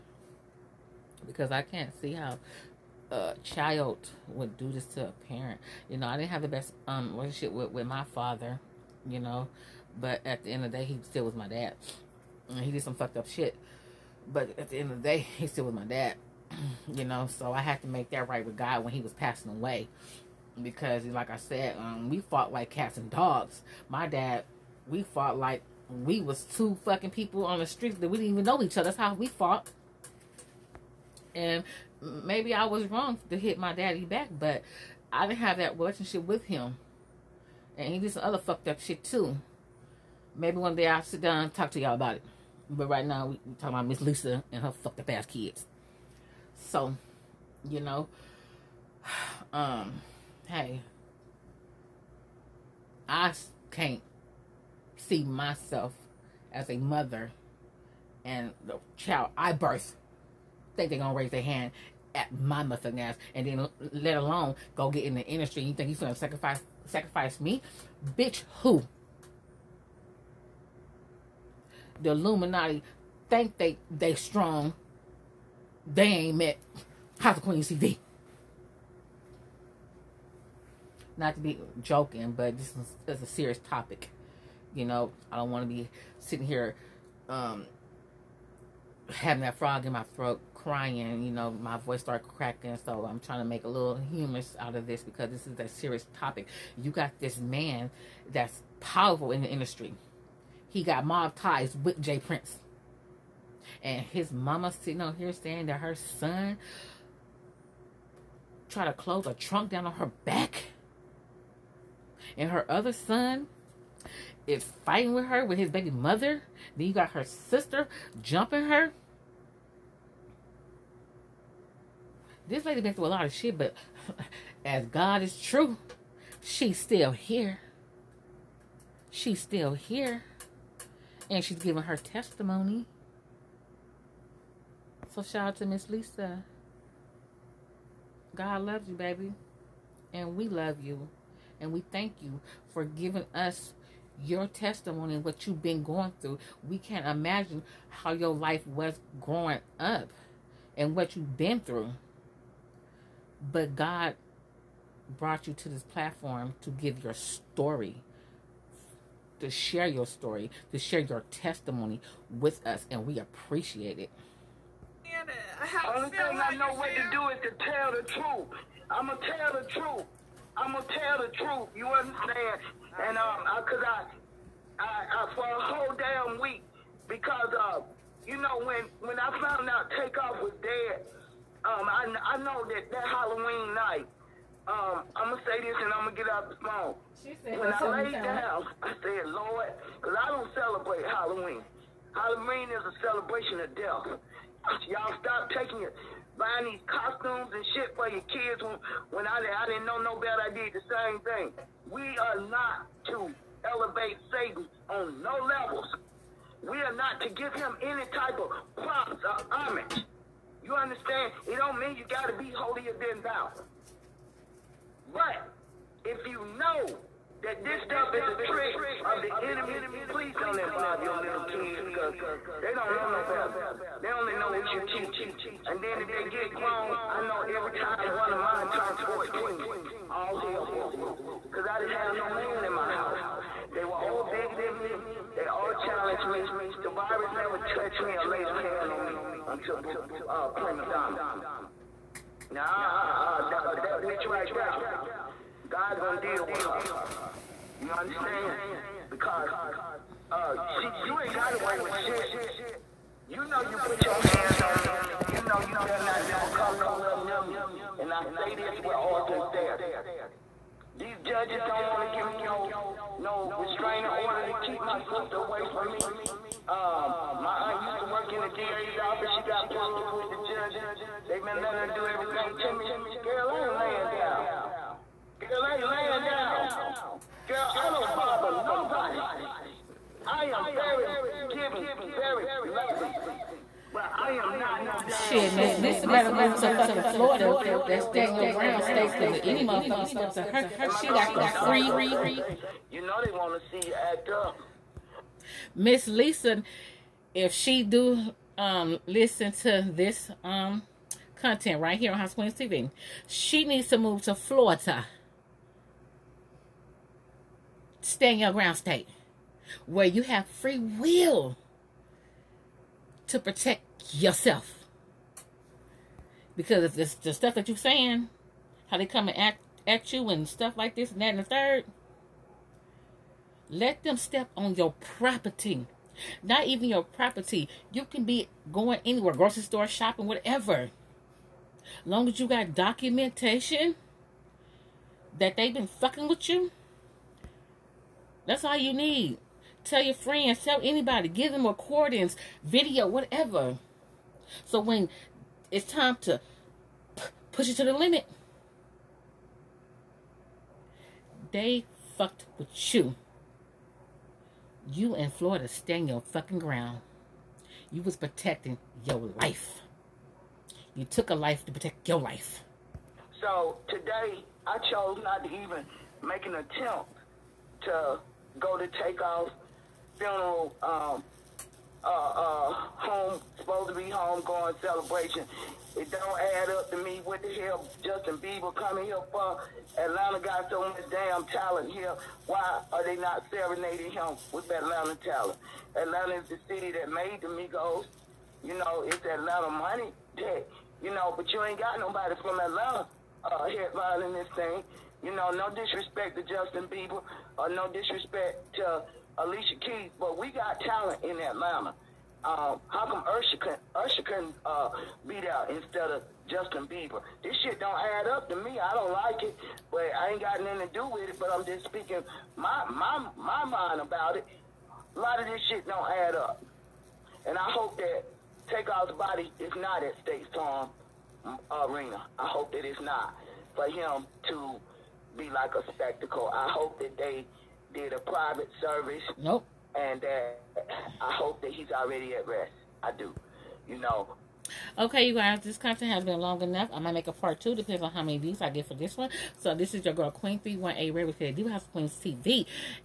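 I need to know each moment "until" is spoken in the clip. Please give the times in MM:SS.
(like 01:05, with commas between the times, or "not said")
03:59.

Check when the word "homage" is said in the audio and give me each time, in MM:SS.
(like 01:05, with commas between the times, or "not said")
03:29.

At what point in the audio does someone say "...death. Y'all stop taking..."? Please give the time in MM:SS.
03:13.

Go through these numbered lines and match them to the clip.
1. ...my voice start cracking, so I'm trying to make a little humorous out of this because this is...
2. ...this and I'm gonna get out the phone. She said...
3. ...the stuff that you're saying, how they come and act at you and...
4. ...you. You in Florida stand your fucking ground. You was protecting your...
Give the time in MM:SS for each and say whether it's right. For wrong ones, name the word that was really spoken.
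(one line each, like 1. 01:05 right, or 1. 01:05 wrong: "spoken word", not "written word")
1. 01:31 right
2. 03:05 right
3. 05:17 right
4. 05:52 right.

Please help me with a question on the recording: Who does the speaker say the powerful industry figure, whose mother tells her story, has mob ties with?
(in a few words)
J Prince.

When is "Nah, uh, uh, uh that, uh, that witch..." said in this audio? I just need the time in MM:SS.
04:02.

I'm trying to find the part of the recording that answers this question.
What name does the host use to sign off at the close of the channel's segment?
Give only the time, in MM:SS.
07:20.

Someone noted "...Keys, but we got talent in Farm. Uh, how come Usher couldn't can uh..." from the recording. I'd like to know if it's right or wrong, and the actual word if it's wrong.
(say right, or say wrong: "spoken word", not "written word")
wrong: "Atlanta", not "Farm".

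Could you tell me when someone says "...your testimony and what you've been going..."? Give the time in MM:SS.
02:24.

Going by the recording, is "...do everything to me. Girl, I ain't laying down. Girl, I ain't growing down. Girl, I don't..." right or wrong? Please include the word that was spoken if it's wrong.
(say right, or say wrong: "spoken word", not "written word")
wrong: "laying", not "growing".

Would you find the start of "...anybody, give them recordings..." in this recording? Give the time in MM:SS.
05:40.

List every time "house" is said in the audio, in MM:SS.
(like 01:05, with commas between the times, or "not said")
01:17, 03:52, 05:02, 07:21.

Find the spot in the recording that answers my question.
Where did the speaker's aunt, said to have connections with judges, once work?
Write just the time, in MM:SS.
04:28.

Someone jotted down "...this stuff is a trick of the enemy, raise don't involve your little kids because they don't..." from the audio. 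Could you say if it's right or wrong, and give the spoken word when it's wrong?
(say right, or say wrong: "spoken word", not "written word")
wrong: "please", not "raise".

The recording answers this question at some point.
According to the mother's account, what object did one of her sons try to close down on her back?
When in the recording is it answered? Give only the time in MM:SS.
01:49.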